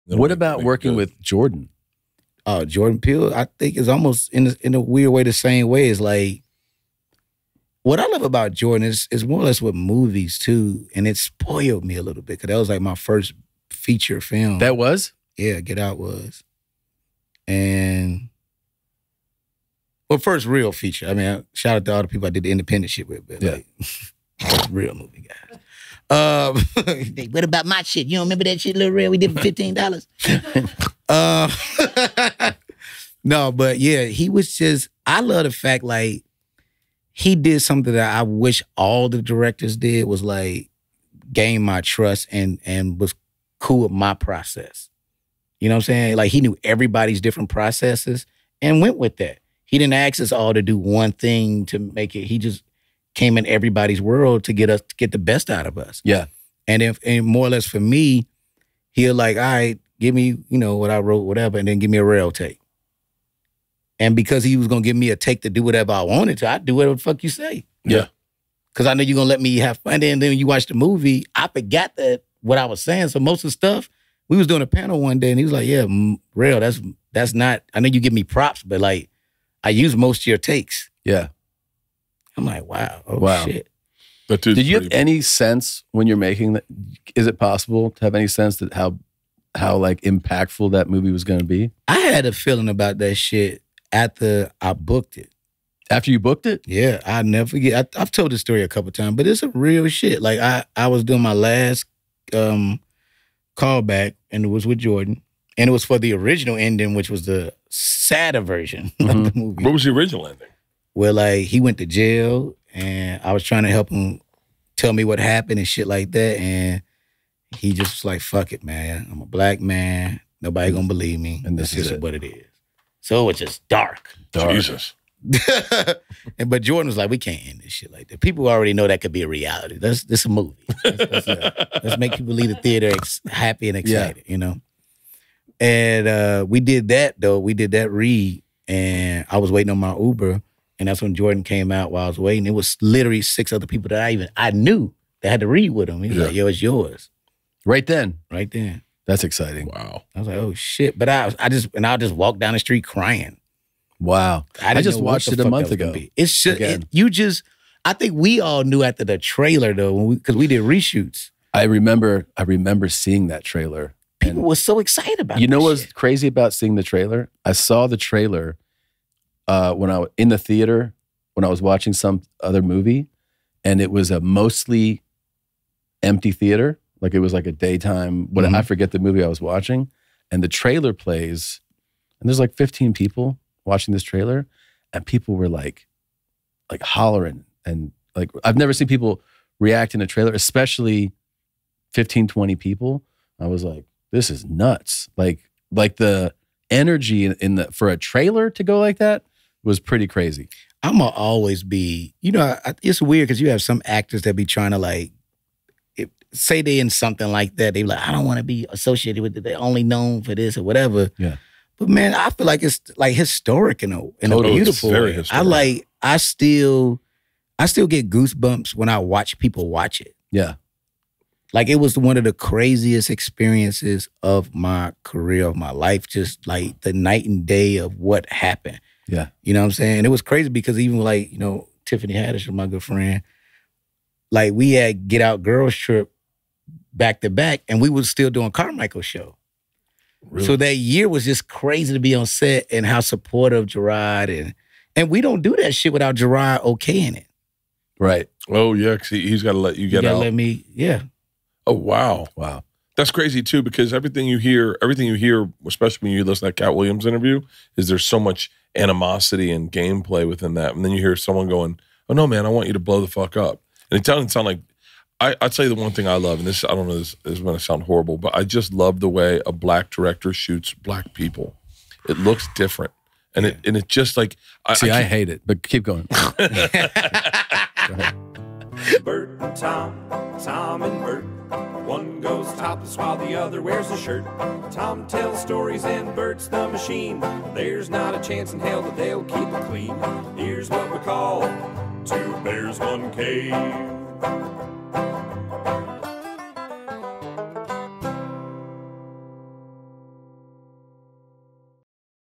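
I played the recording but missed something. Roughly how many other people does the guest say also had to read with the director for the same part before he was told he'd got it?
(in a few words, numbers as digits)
6.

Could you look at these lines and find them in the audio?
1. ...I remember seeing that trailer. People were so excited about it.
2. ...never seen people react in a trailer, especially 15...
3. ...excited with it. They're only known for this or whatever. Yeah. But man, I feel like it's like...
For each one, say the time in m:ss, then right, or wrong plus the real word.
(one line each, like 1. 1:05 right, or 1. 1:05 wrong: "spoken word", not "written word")
1. 2:42 right
2. 3:08 right
3. 3:28 wrong: "associated", not "excited".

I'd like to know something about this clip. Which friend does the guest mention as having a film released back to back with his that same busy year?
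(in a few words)
Tiffany Haddish.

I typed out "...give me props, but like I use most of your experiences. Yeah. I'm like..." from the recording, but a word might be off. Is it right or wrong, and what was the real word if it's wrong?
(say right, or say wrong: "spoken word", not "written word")
wrong: "takes", not "experiences".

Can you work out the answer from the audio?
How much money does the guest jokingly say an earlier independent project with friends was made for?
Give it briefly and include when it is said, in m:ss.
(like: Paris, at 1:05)
$15, at 0:29.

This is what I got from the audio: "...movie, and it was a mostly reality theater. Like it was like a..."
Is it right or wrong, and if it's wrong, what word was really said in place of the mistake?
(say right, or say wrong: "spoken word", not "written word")
wrong: "empty", not "reality".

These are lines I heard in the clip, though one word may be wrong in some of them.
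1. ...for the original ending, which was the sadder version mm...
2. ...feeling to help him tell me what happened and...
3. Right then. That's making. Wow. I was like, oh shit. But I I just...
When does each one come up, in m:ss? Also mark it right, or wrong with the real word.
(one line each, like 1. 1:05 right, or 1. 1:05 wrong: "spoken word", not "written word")
1. 1:45 right
2. 1:53 wrong: "trying", not "feeling"
3. 2:28 wrong: "exciting", not "making".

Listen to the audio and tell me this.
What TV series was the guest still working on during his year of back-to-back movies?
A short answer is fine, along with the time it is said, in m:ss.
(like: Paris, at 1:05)
Carmichael show, at 3:58.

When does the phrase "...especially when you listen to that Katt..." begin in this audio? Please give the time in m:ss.
4:15.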